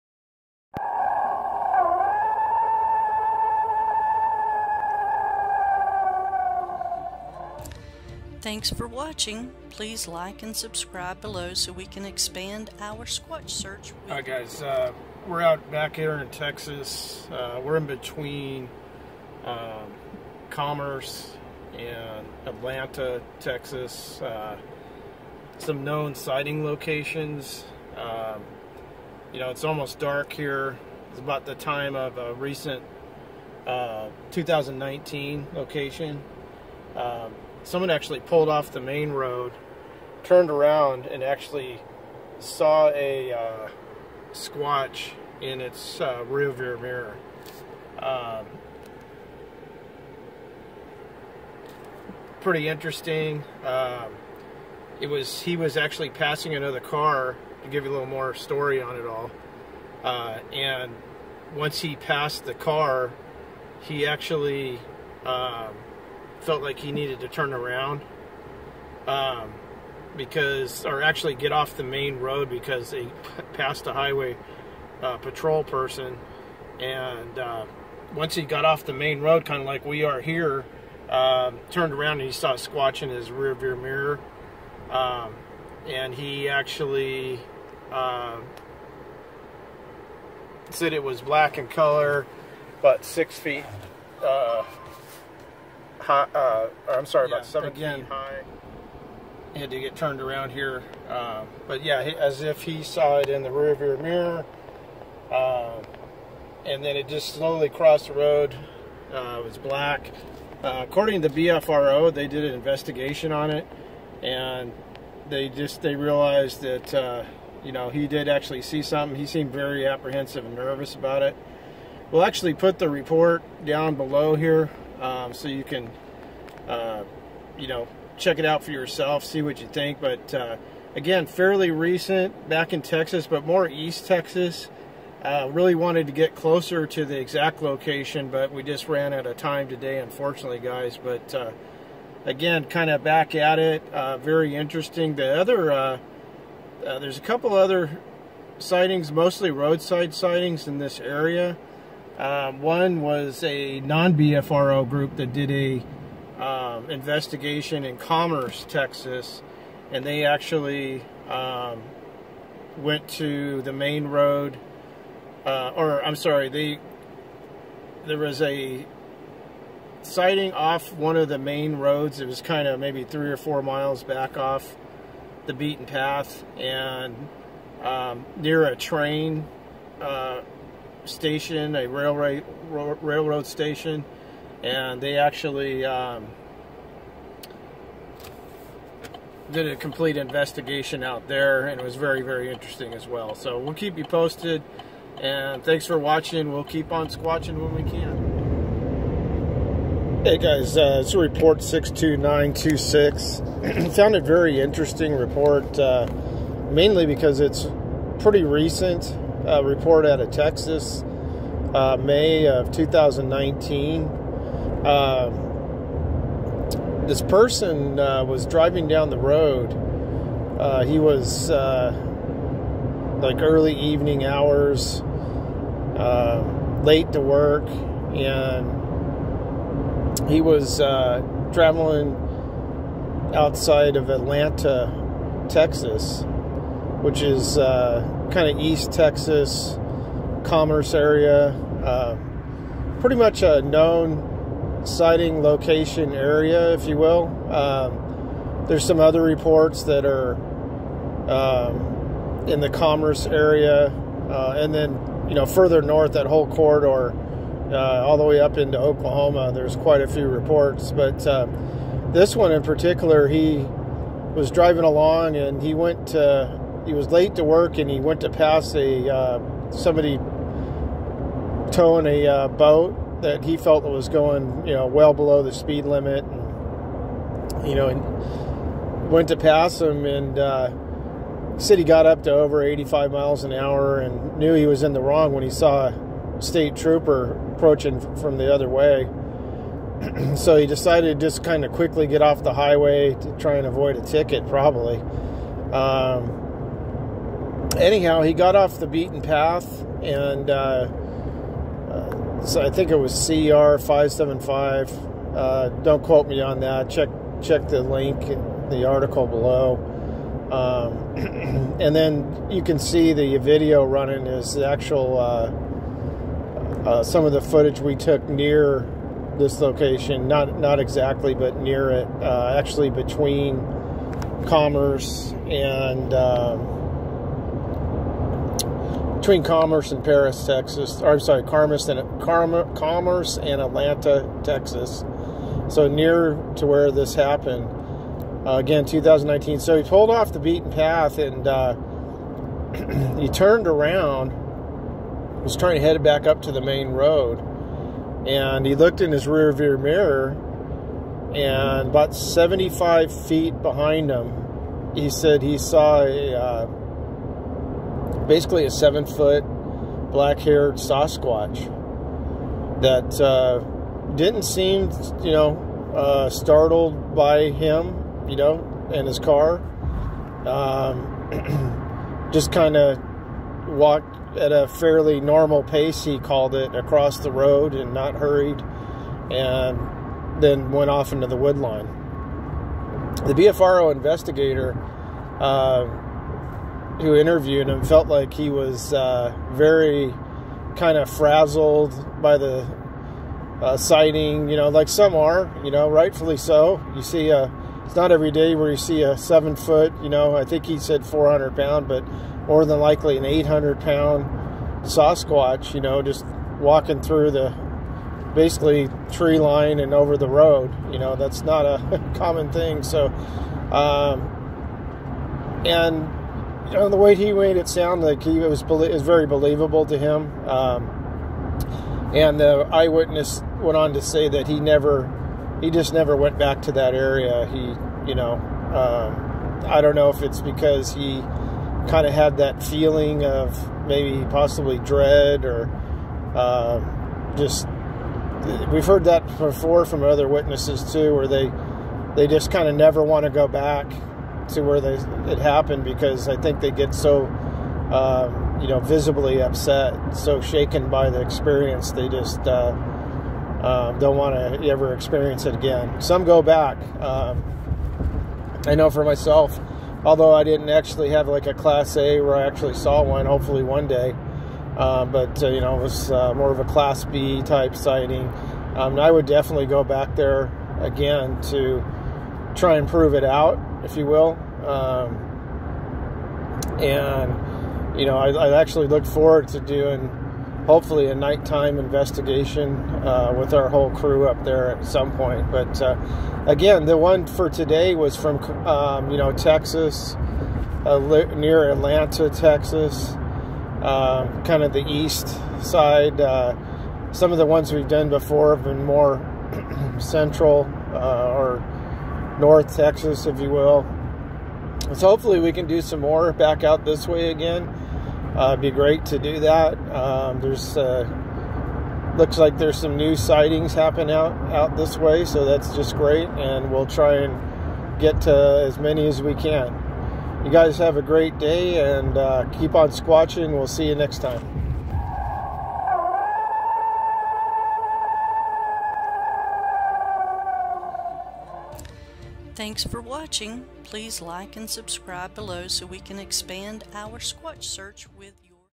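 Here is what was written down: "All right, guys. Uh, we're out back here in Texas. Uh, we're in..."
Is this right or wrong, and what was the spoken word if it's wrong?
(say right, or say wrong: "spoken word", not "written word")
right.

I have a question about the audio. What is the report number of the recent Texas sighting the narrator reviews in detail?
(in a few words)
62926.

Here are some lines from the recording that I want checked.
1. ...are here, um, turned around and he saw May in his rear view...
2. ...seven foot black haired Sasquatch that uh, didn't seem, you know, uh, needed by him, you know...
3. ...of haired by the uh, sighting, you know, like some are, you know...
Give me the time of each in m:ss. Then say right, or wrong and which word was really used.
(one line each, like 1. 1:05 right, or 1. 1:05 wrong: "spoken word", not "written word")
1. 1:20 wrong: "Squatch", not "May"
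2. 5:58 wrong: "startled", not "needed"
3. 6:30 wrong: "frazzled", not "haired".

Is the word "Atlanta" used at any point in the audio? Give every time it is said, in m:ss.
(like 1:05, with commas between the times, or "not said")
0:22, 3:54, 5:33, 8:11.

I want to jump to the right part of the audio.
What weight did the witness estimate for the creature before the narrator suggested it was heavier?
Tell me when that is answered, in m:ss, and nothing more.
6:41.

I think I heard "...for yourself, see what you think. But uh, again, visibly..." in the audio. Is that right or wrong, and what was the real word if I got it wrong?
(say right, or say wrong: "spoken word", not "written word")
wrong: "fairly", not "visibly".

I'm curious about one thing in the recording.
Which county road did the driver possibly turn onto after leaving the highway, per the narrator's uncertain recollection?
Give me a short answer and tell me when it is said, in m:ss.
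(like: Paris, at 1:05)
CR 575, at 5:03.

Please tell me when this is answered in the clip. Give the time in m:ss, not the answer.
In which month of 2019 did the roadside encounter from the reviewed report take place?
3:31.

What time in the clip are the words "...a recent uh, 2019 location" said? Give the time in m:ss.
0:32.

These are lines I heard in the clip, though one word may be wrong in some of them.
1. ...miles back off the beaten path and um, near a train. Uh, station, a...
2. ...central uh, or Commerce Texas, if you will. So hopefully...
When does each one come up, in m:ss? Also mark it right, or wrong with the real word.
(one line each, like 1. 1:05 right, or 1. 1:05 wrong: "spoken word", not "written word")
1. 2:53 right
2. 8:19 wrong: "North", not "Commerce".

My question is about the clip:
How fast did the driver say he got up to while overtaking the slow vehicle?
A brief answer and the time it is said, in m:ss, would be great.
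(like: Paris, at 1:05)
over 85 miles an hour, at 4:42.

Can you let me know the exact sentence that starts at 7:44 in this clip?
Uh, but uh, you know it was uh, more of a class B type sighting.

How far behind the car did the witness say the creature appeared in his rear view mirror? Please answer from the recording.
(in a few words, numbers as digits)
75 feet.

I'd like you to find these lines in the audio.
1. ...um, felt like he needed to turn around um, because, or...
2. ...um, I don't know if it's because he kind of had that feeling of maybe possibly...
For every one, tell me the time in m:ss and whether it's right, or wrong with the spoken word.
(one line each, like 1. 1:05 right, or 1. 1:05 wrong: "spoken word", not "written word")
1. 1:05 right
2. 7:08 right.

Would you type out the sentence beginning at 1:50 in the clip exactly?
Uh, according to the BFRO, they did an investigation on it.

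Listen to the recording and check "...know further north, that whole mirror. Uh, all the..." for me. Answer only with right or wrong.
wrong.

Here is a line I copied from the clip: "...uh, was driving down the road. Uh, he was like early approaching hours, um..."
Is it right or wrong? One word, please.
wrong.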